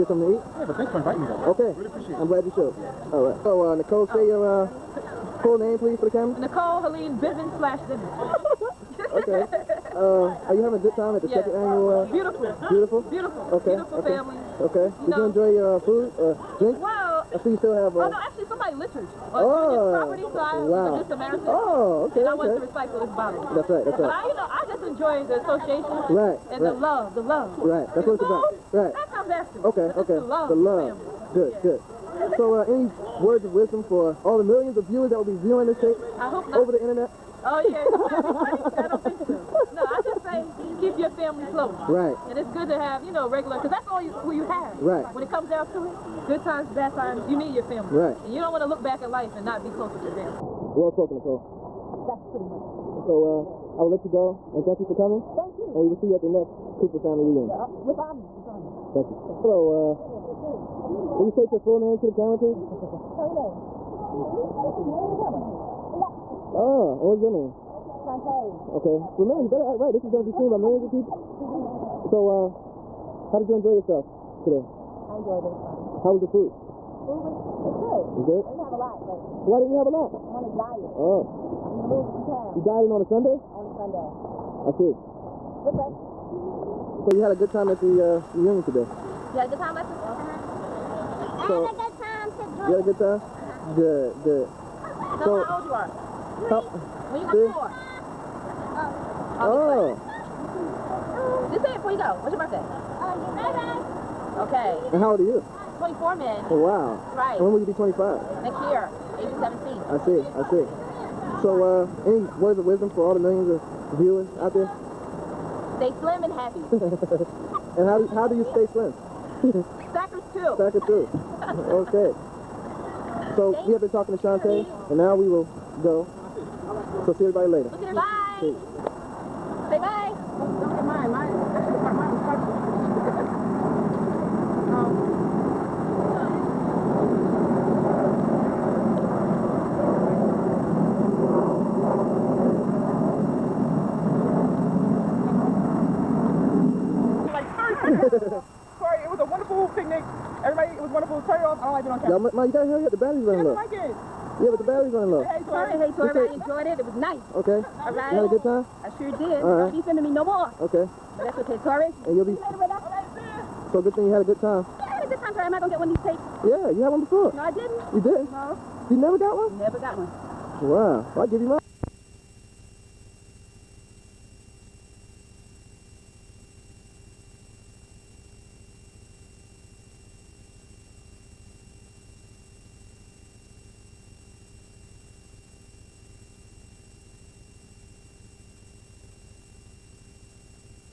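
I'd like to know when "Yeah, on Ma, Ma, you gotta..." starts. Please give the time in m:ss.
2:31.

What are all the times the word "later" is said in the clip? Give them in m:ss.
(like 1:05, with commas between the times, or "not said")
2:07, 2:42.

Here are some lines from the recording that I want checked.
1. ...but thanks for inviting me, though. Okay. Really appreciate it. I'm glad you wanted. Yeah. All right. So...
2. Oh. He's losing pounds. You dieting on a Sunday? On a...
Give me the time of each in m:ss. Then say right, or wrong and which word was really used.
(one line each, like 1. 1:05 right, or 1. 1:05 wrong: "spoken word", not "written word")
1. 0:00 wrong: "showed", not "wanted"
2. 1:20 right.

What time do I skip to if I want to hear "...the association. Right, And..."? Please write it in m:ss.
0:25.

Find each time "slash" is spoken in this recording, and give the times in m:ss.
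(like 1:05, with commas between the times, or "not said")
0:07.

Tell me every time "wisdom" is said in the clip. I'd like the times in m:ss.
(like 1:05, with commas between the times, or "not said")
0:33, 1:52.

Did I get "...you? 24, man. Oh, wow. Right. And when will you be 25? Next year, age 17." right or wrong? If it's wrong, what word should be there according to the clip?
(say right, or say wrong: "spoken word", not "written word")
right.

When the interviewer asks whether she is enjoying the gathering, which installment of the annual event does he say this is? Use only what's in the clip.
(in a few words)
second annual.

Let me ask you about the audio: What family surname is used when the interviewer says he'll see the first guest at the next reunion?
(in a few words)
Cooper.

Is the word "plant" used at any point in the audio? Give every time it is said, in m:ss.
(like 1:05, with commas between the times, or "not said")
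not said.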